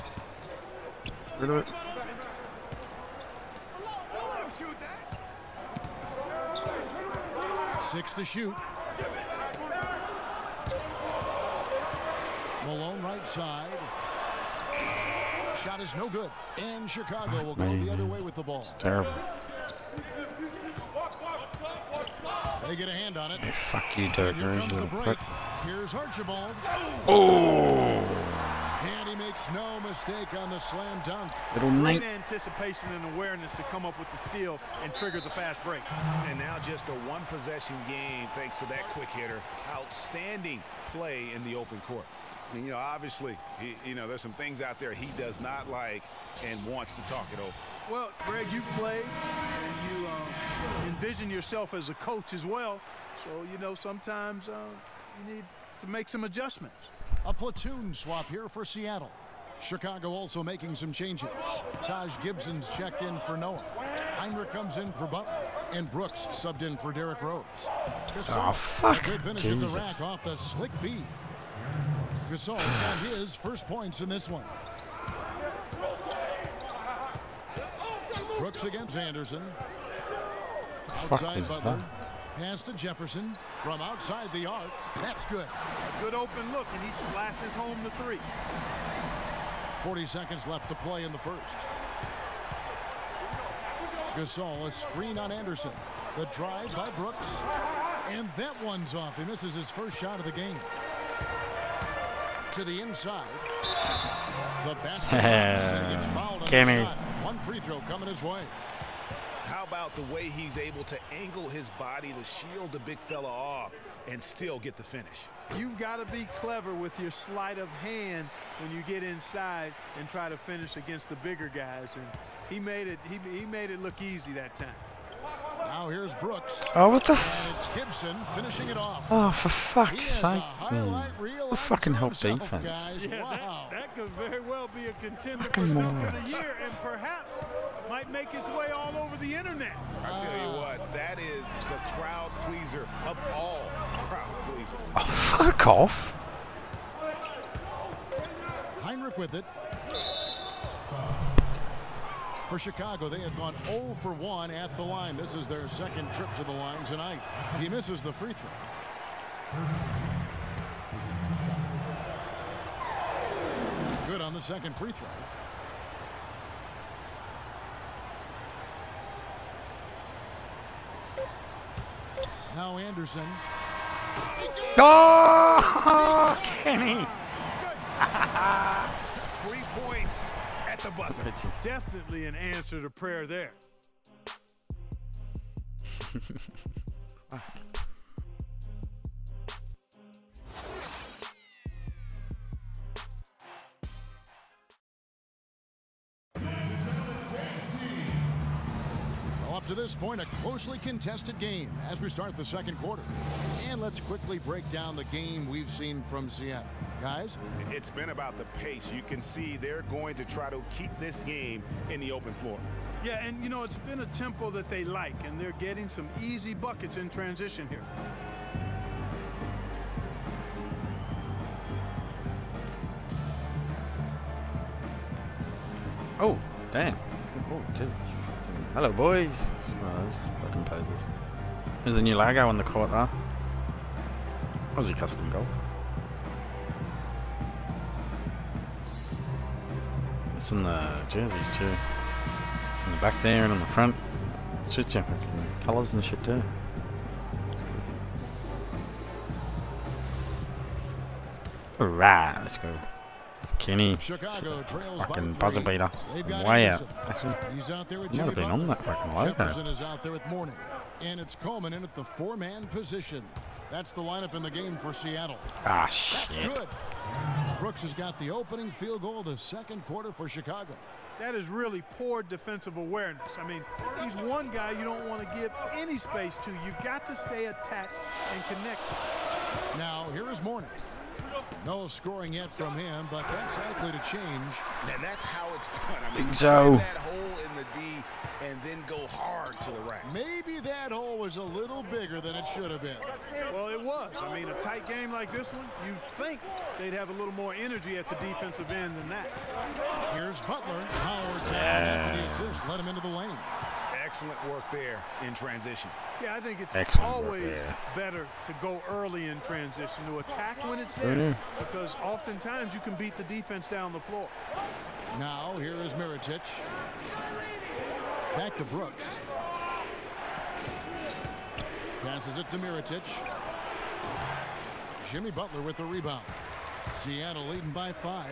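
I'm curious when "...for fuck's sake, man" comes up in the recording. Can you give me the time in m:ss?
2:09.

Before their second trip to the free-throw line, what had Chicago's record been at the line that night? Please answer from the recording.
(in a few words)
0 for 1.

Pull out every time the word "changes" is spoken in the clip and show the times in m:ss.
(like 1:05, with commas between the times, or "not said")
1:00, 4:44.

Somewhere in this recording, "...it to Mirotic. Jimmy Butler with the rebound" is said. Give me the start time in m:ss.
5:22.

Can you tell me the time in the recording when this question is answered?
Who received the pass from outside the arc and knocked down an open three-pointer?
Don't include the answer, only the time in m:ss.
1:22.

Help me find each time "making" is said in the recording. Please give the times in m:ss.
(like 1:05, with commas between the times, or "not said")
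1:00.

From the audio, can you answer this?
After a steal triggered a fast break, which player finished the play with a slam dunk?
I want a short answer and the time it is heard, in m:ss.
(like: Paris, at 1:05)
Archibald, at 0:25.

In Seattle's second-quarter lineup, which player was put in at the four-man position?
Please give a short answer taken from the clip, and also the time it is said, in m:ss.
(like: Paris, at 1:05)
Coleman, at 4:21.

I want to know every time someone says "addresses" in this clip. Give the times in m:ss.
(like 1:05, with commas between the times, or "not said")
not said.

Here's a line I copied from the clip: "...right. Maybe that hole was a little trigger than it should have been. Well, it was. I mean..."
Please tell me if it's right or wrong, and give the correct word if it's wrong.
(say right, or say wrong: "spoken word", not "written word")
wrong: "bigger", not "trigger".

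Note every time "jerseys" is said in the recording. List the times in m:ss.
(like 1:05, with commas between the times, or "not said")
4:01.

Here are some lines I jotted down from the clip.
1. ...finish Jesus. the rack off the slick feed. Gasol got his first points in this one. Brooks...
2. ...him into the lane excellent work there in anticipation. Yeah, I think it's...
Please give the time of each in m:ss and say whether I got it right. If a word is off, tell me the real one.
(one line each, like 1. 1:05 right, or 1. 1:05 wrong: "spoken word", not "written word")
1. 1:09 right
2. 5:02 wrong: "transition", not "anticipation".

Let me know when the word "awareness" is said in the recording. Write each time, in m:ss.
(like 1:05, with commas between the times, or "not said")
0:33, 4:32.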